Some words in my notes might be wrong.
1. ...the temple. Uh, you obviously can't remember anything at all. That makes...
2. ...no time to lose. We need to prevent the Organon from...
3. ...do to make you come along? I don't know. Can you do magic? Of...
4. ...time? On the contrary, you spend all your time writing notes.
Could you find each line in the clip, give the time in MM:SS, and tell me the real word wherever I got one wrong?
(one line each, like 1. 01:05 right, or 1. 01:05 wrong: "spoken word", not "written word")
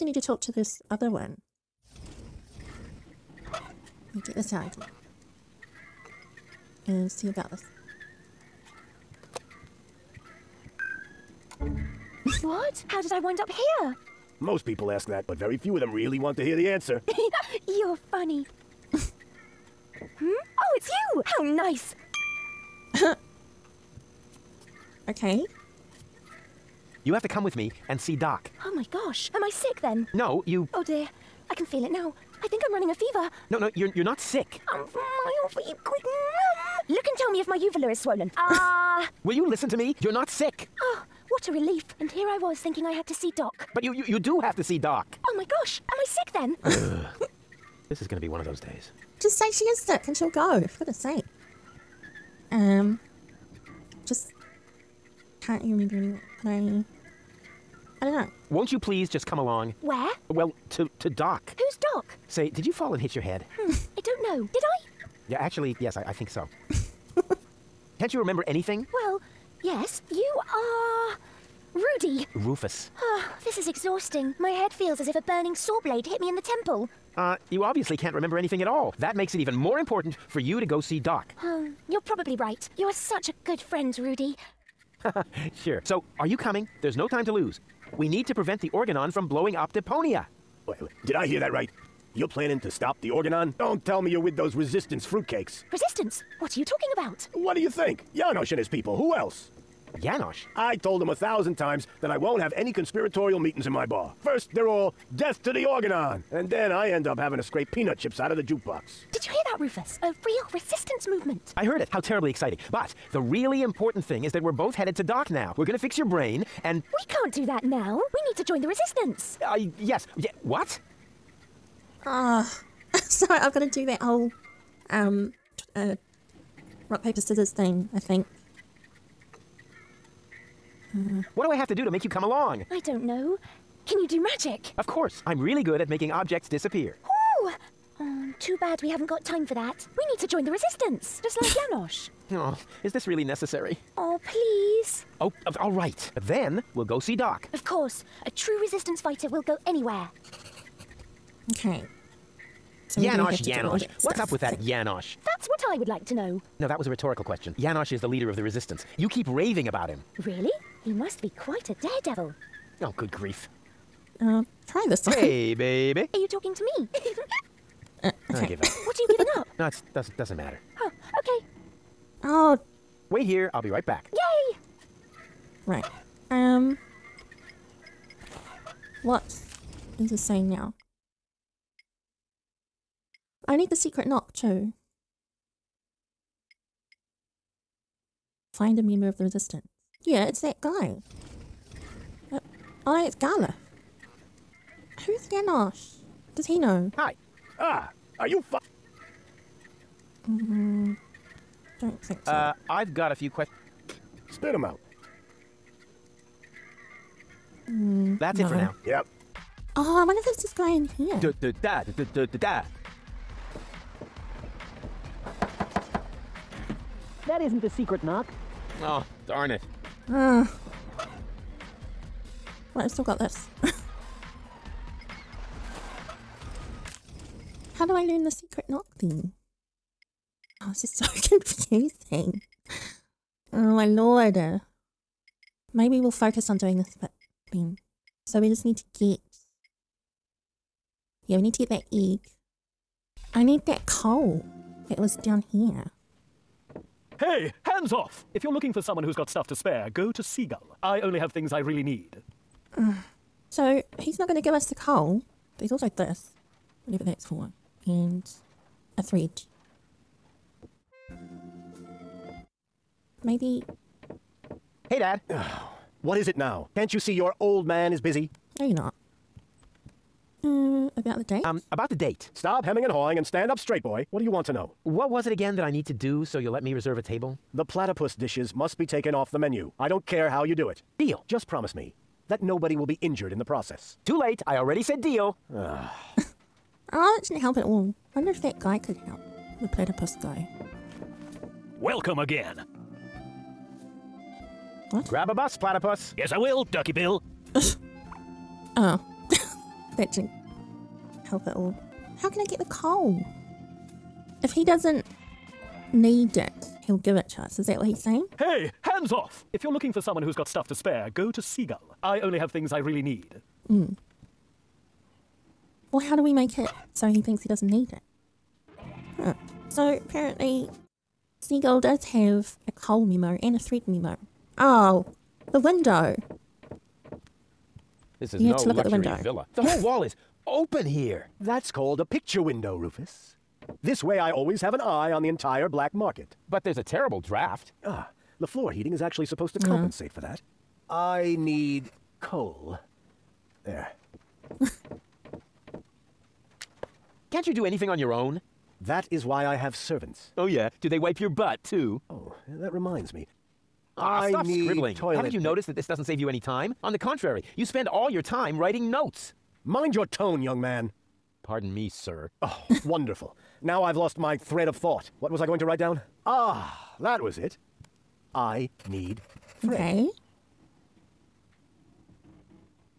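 1. 01:16 right
2. 01:26 right
3. 02:11 right
4. 05:56 right.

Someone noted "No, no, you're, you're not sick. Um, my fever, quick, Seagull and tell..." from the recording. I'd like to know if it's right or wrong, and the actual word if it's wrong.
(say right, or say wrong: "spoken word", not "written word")
wrong: "Look", not "Seagull".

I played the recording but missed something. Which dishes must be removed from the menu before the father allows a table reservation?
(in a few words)
Platypus dishes.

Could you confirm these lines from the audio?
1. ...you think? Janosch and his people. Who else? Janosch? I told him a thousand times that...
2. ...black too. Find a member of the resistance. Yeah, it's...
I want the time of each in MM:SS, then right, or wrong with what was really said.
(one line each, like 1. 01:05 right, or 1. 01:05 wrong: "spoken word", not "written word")
1. 01:37 right
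2. 03:04 wrong: "knock", not "black".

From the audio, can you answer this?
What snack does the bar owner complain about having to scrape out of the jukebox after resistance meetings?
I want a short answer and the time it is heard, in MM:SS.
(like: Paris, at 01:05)
Peanut chips, at 01:47.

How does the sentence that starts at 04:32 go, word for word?
Stop hemming and hawing and stand up straight, boy.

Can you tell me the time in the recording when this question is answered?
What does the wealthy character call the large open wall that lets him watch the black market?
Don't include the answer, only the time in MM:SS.
05:32.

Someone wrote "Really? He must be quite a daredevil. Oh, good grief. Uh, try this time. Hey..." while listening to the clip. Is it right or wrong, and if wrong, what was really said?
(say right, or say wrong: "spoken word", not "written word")
right.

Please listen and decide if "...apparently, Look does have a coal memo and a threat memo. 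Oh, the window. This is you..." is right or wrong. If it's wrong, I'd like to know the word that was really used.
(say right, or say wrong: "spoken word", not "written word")
wrong: "Seagull", not "Look".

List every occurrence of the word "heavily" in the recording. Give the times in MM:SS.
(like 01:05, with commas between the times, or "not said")
not said.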